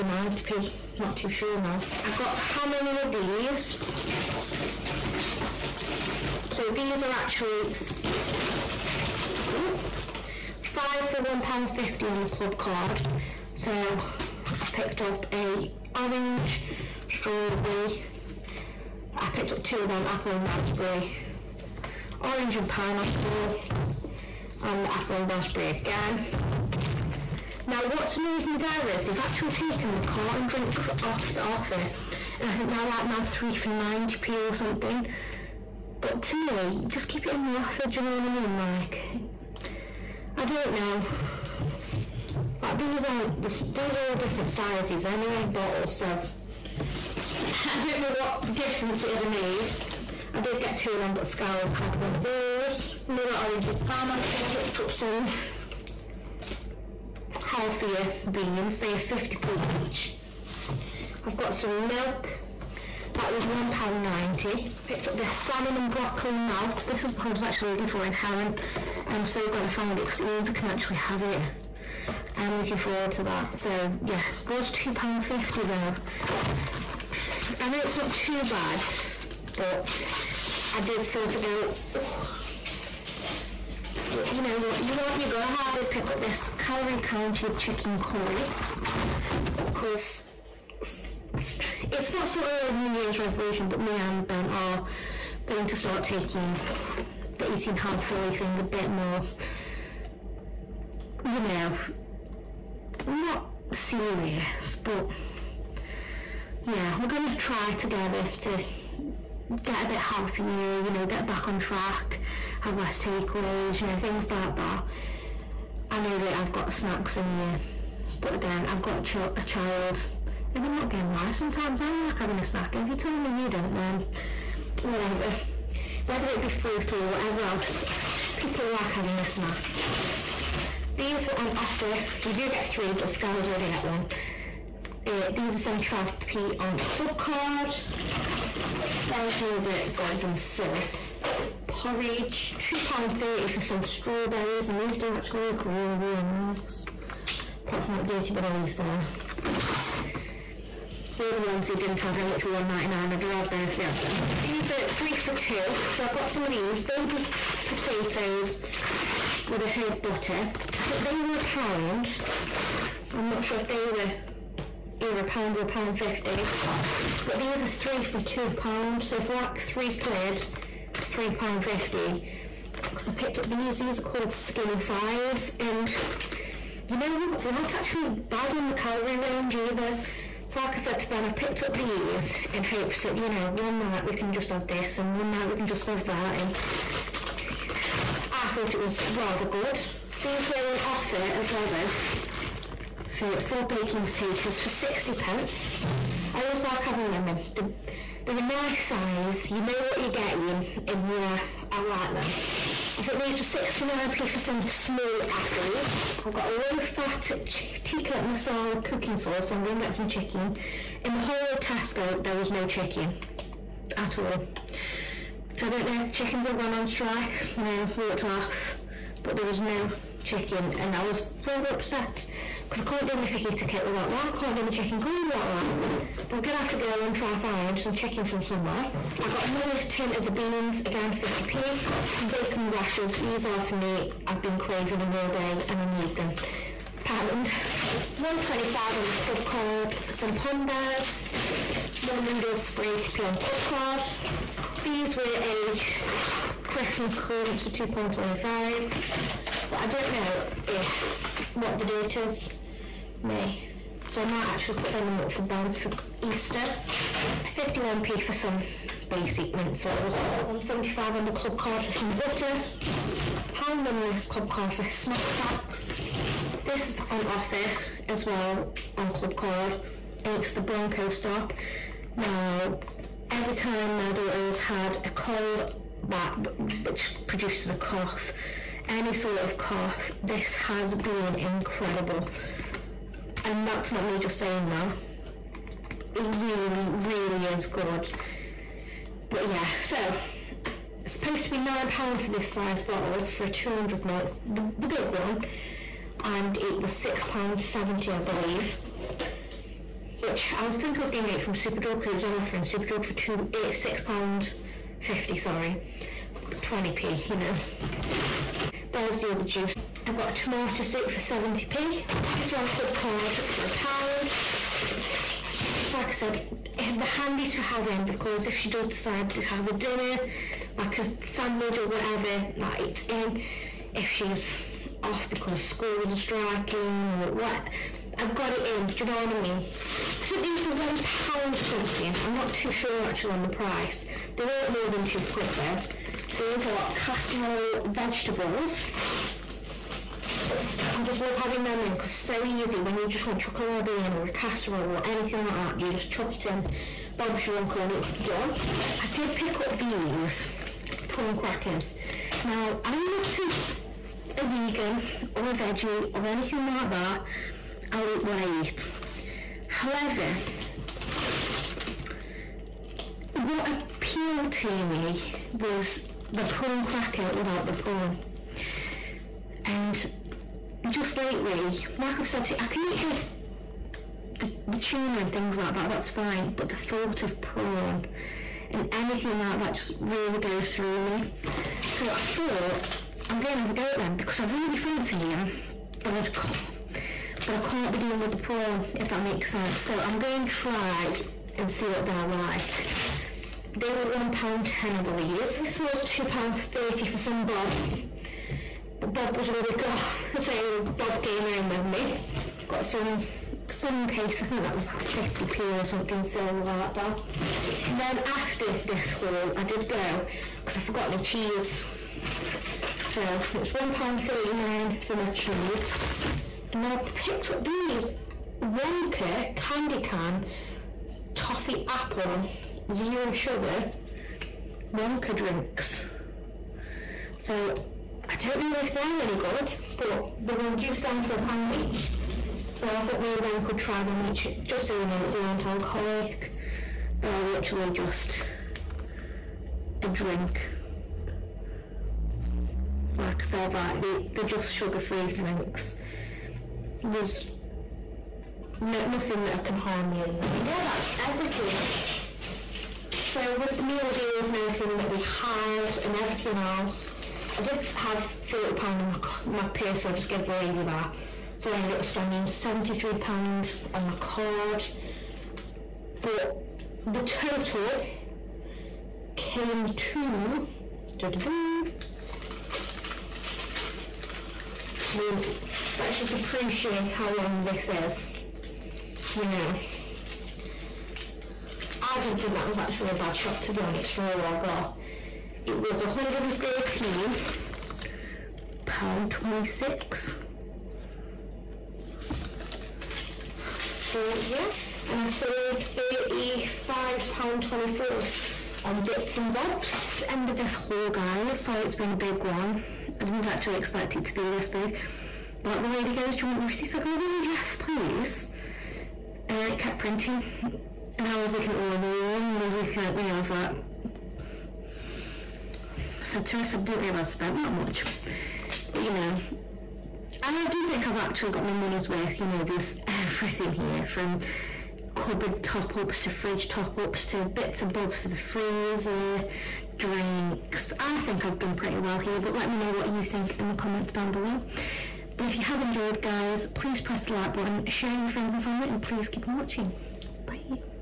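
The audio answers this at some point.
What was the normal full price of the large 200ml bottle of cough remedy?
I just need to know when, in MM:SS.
04:51.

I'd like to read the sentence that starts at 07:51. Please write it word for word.
I mean, let's just appreciate how long this is, you know.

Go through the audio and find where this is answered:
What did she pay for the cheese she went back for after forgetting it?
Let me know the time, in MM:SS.
06:53.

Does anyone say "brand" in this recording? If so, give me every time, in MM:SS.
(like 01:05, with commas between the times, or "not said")
not said.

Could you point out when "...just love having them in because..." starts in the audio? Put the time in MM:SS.
05:41.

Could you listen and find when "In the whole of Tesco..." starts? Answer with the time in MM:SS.
03:31.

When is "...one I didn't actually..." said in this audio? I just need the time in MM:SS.
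08:22.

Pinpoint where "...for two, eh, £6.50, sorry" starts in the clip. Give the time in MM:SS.
05:03.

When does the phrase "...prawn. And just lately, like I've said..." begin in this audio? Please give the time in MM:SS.
06:07.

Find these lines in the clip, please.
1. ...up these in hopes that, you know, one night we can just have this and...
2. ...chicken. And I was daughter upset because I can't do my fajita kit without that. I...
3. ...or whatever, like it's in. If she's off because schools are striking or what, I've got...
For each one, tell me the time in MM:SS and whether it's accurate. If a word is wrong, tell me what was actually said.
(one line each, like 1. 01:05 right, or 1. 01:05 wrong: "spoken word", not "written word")
1. 03:01 right
2. 03:40 wrong: "rather", not "daughter"
3. 05:21 right.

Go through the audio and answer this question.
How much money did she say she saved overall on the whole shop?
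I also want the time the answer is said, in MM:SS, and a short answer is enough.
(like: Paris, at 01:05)
£35.24, at 08:15.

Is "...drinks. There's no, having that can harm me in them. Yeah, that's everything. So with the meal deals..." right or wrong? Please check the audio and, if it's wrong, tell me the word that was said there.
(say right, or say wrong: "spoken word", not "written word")
wrong: "nothing", not "having".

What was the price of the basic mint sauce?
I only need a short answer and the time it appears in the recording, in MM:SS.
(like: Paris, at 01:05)
51p, at 04:17.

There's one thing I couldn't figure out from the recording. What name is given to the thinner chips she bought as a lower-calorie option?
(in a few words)
skinny fries.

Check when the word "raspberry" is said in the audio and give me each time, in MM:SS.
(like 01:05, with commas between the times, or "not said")
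00:20, 00:25.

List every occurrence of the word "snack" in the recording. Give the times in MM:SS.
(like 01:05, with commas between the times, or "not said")
01:56, 02:02, 02:09, 04:24.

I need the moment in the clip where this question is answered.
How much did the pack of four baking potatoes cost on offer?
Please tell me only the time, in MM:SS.
03:14.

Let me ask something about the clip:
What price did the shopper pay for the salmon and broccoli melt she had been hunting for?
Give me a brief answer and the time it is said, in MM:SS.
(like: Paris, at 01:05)
£2.50, at 01:14.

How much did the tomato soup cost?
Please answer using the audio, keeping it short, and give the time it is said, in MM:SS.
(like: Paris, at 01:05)
70p, at 05:11.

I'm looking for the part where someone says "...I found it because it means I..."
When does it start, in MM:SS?
01:09.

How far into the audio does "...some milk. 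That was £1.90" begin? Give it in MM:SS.
01:01.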